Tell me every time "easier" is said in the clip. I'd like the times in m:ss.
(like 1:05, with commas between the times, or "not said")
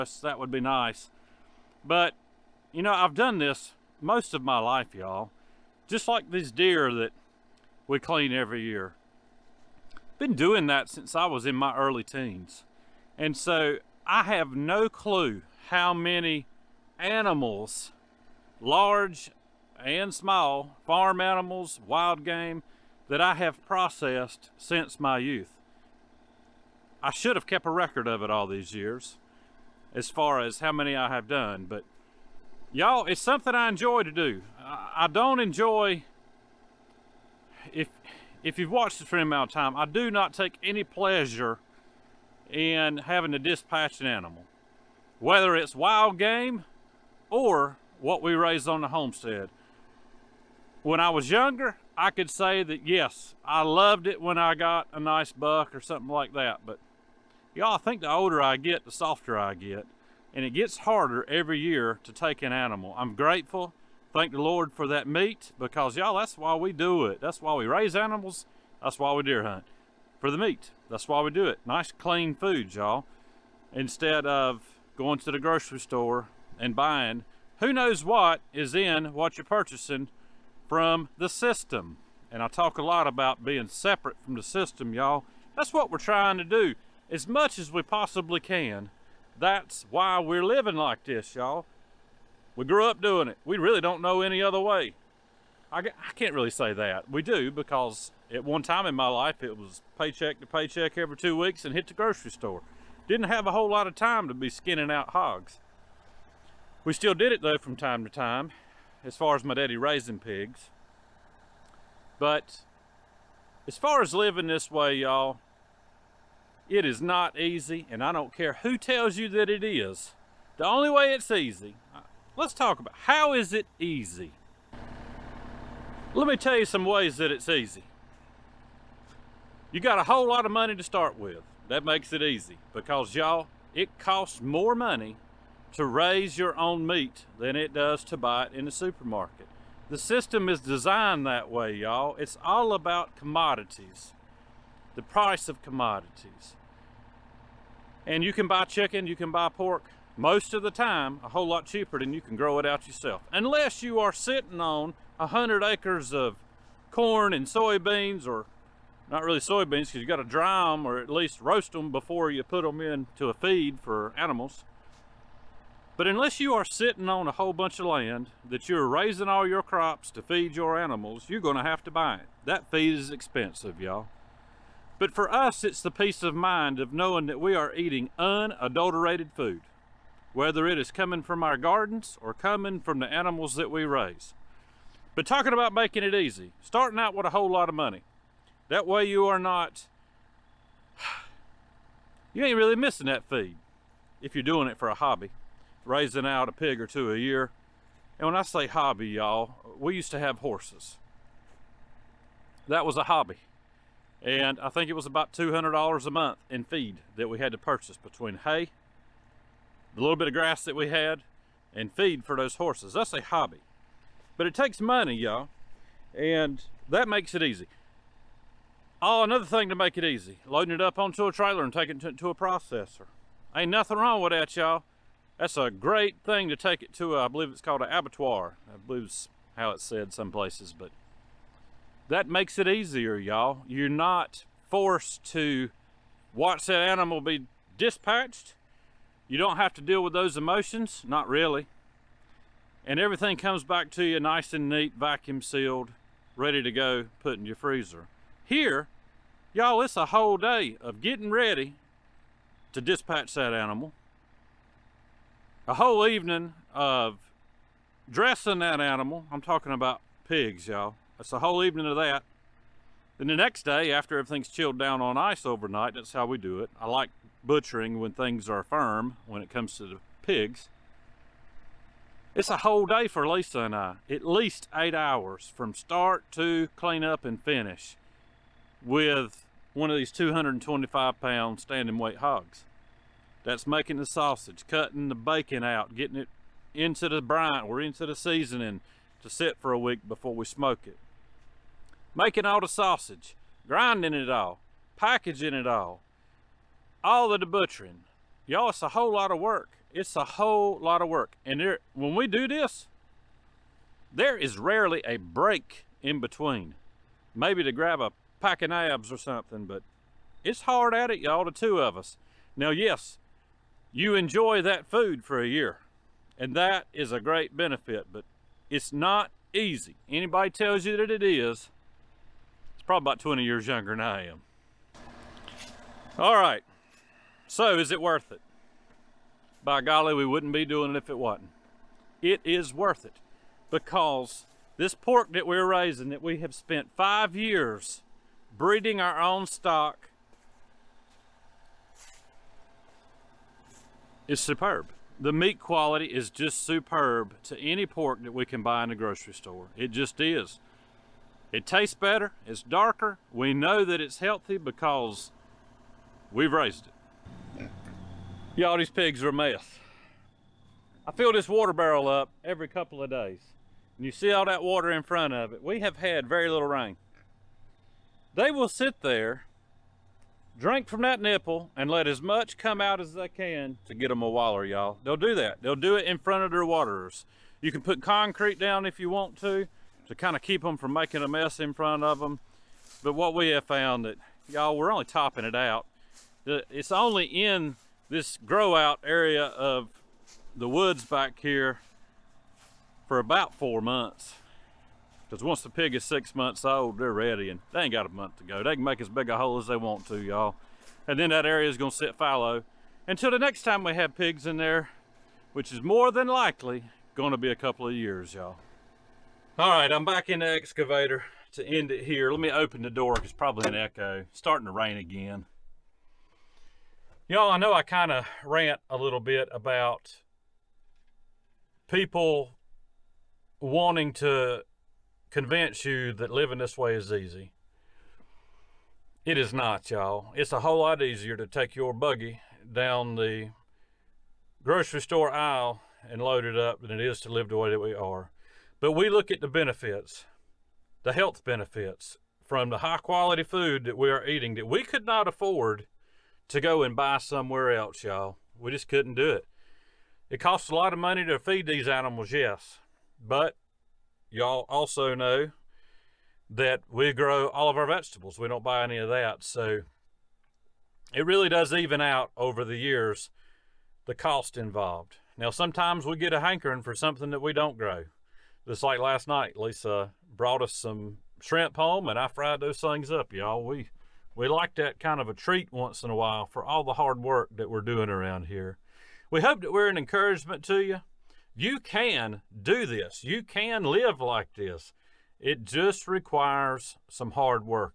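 3:52, 7:11.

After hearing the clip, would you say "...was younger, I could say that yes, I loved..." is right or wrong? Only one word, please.
right.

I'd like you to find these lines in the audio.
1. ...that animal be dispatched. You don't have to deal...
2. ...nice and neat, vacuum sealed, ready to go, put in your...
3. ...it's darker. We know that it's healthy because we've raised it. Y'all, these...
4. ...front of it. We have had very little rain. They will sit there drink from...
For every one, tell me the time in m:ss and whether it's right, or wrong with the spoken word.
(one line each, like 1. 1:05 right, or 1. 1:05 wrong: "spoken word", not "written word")
1. 3:56 right
2. 4:04 right
3. 5:52 right
4. 6:05 right.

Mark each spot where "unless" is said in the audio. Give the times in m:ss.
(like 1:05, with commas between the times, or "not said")
2:33, 2:46.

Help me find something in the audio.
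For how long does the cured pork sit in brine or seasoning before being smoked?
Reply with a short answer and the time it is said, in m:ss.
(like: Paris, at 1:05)
a week, at 4:49.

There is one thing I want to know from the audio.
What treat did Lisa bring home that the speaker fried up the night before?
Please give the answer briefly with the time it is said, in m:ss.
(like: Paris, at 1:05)
shrimp, at 7:51.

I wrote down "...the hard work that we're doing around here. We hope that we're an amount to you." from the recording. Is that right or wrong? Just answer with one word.
wrong.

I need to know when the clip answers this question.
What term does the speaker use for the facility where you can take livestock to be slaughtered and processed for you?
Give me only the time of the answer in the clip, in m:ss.
3:47.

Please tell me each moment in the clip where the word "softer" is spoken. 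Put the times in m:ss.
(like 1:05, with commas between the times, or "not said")
0:58.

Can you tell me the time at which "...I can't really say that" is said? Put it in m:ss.
1:35.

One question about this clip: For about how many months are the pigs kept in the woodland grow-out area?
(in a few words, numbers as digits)
4 months.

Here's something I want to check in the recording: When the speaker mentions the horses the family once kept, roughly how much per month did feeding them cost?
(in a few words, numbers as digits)
$200.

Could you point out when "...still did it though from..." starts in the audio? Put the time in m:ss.
1:46.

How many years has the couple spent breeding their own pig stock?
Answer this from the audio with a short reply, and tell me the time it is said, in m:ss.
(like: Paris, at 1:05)
5 years, at 5:36.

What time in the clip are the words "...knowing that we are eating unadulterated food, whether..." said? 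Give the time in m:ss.
2:56.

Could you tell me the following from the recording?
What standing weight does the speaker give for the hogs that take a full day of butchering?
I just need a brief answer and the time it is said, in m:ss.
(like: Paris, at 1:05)
225 pounds, at 4:40.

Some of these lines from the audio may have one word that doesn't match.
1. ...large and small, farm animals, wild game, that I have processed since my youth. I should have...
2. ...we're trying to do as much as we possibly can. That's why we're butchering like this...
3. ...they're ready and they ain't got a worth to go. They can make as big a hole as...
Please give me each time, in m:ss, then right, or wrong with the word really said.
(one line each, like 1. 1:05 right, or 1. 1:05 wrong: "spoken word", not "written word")
1. 0:18 right
2. 1:25 wrong: "living", not "butchering"
3. 6:36 wrong: "month", not "worth".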